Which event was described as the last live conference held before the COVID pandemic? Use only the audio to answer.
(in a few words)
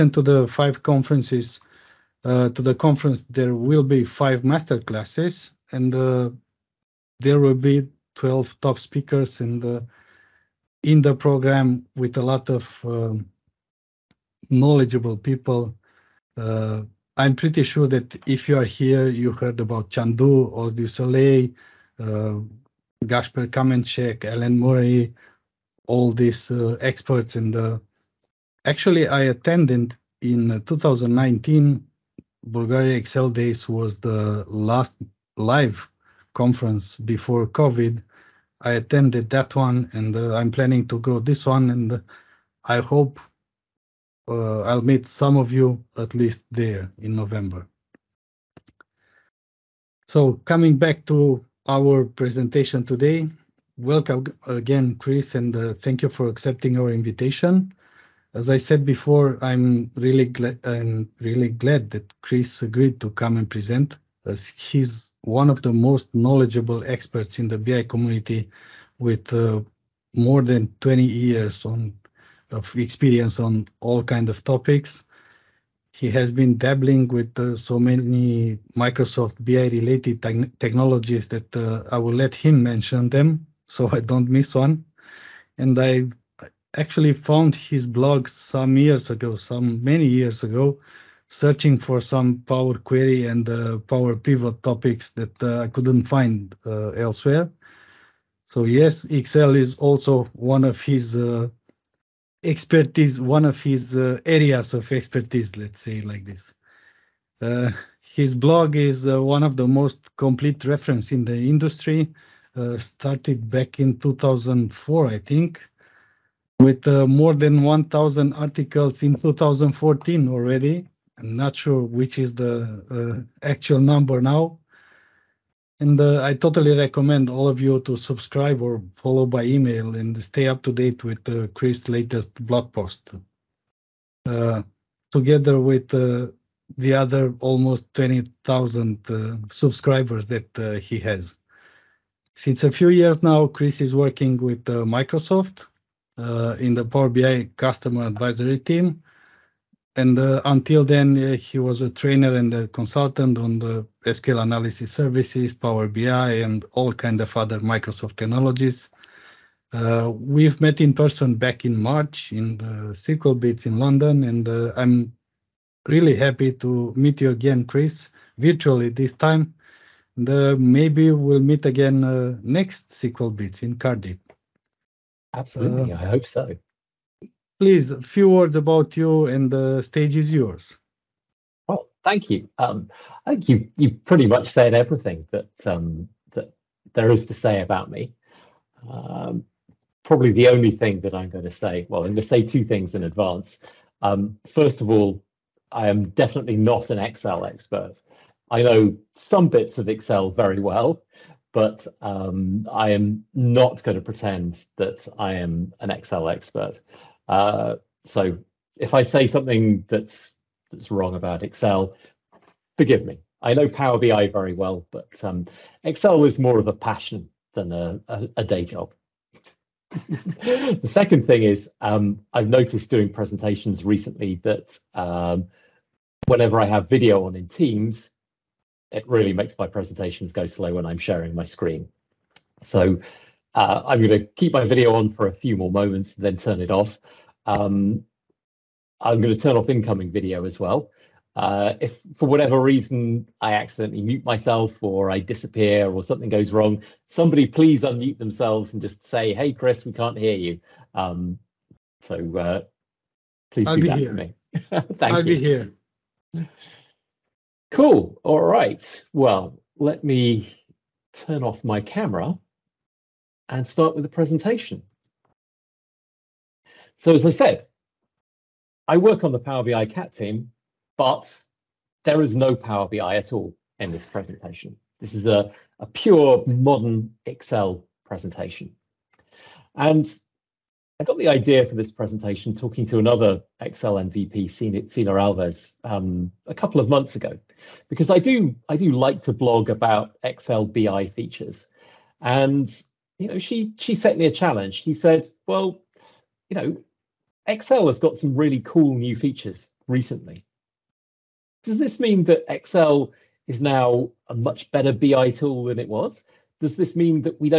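Bulgaria Excel Days.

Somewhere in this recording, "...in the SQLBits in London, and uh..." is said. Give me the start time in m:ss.
2:42.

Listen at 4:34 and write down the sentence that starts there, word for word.
This is a, a pure modern Excel presentation.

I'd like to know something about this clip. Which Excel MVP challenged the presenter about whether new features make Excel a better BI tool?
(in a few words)
Celia Alves.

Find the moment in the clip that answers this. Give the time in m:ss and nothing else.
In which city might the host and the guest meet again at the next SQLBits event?
2:53.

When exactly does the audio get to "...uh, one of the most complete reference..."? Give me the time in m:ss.
1:49.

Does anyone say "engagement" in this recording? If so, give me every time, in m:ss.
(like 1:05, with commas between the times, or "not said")
not said.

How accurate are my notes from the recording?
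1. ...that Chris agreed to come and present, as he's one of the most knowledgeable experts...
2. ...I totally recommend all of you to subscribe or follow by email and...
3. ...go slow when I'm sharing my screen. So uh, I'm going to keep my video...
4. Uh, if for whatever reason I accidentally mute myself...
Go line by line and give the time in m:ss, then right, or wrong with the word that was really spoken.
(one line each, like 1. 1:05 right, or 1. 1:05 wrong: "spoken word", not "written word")
1. 1:01 right
2. 2:06 right
3. 3:50 right
4. 4:01 right.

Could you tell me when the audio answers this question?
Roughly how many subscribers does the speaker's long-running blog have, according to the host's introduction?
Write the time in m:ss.
2:17.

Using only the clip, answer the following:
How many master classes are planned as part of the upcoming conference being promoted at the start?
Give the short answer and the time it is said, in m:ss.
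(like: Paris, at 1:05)
5, at 0:04.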